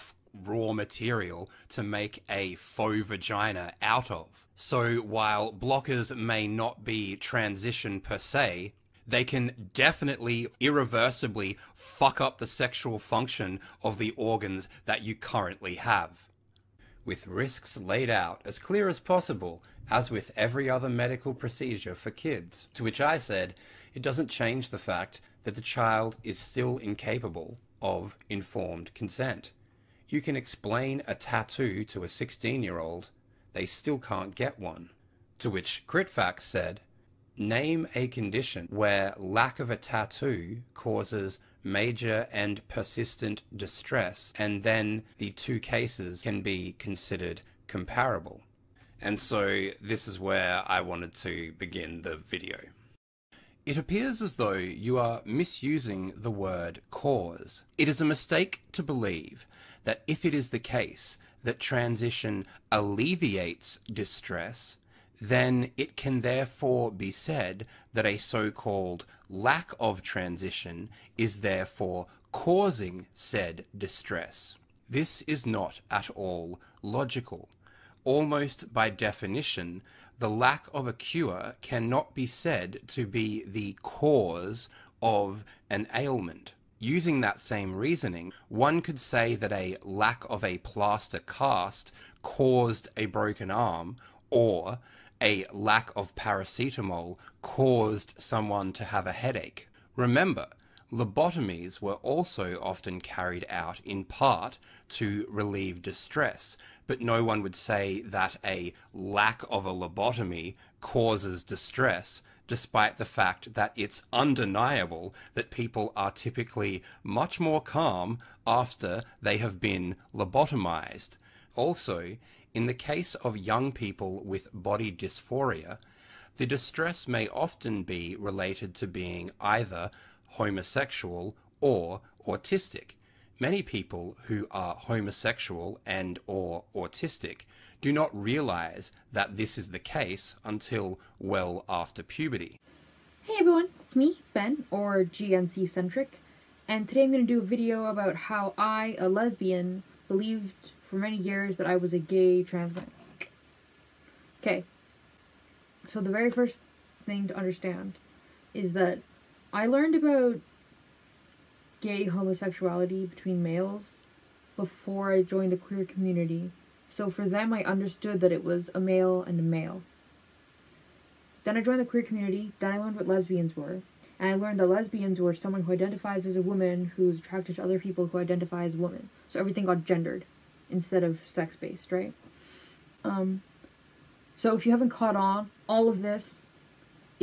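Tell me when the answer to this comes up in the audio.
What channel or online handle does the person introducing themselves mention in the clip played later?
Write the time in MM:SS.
02:25.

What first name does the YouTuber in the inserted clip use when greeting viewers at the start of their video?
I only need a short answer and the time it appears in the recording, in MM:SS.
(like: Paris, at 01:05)
Ben, at 02:24.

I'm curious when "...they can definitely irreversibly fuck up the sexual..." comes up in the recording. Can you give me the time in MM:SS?
00:09.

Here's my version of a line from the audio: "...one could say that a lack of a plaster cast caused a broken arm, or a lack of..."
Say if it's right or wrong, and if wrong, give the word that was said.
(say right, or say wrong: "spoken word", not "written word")
right.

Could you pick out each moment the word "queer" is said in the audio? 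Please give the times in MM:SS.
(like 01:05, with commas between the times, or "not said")
02:45, 02:51.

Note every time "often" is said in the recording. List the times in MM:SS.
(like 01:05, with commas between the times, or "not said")
01:42, 02:07.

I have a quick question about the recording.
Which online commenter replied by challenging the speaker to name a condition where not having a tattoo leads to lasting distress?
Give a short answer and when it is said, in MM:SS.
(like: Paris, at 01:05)
CritFacts, at 00:35.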